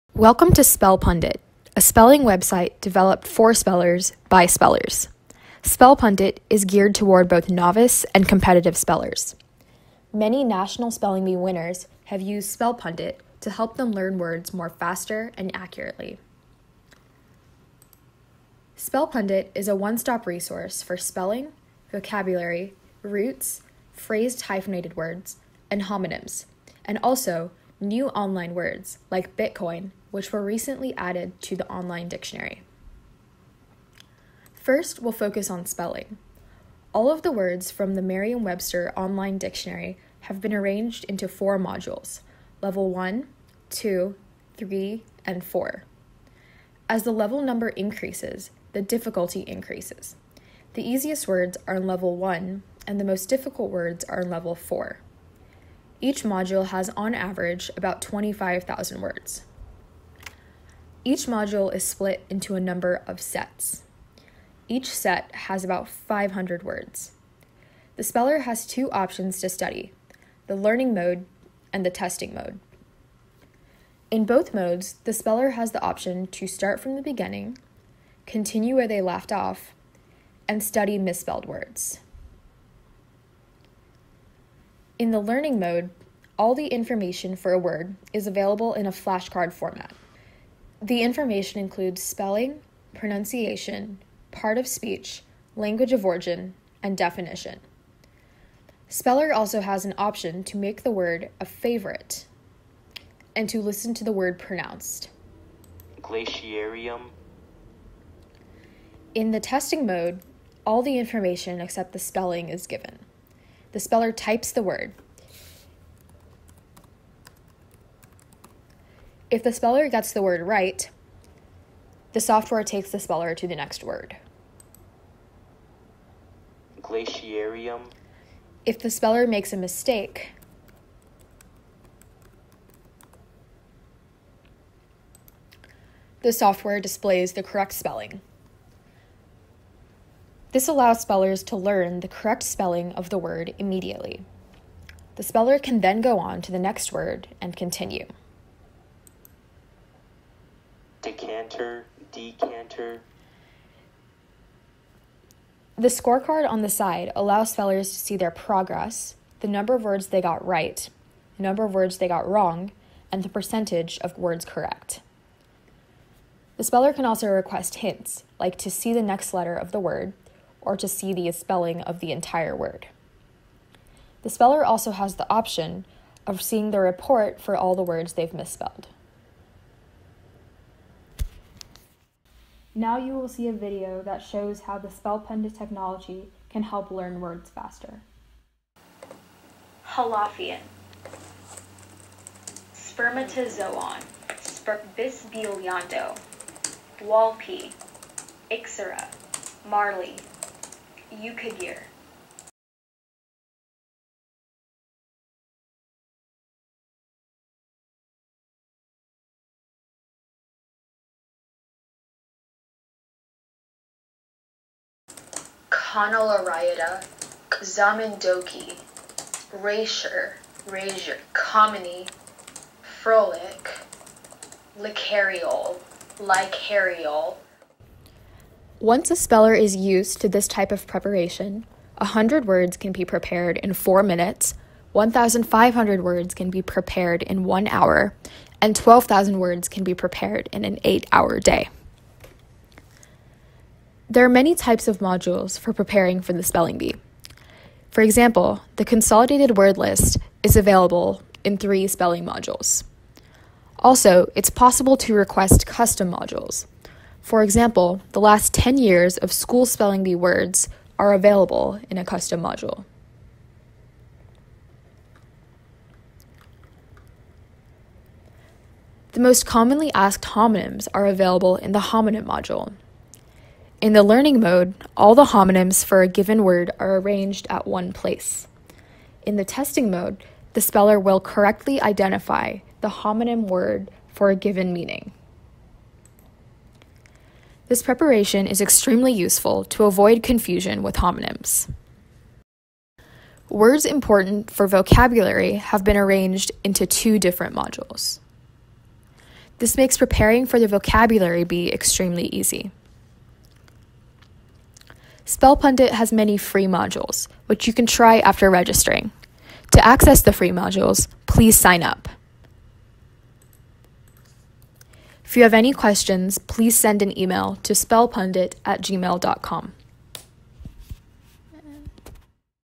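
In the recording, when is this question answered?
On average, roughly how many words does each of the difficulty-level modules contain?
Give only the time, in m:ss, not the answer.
0:58.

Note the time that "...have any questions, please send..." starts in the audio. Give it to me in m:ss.
5:15.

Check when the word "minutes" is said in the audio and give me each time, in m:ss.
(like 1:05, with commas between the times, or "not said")
3:54.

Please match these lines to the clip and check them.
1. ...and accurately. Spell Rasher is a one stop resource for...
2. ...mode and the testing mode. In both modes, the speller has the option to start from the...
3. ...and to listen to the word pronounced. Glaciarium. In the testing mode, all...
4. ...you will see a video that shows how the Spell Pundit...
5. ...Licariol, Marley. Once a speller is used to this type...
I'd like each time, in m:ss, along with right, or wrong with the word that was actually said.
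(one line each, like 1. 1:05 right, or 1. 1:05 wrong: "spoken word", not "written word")
1. 0:15 wrong: "Pundit", not "Rasher"
2. 1:10 right
3. 1:43 right
4. 3:02 right
5. 3:44 wrong: "Licariol", not "Marley".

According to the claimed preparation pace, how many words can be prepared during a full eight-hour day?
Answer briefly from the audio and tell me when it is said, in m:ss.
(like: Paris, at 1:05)
12,000, at 3:58.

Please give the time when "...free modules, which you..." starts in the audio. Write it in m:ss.
5:06.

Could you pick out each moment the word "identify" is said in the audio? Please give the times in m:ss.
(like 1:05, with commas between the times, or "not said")
4:41.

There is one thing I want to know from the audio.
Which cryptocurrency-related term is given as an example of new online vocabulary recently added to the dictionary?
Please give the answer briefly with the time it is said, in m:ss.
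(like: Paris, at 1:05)
Bitcoin, at 0:29.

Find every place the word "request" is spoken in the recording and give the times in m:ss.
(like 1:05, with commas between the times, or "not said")
2:47, 4:15.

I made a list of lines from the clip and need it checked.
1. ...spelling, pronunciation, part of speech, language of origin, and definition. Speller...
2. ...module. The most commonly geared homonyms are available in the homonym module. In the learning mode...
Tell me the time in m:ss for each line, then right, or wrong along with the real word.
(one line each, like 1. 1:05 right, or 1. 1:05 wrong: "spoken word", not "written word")
1. 1:32 right
2. 4:22 wrong: "asked", not "geared".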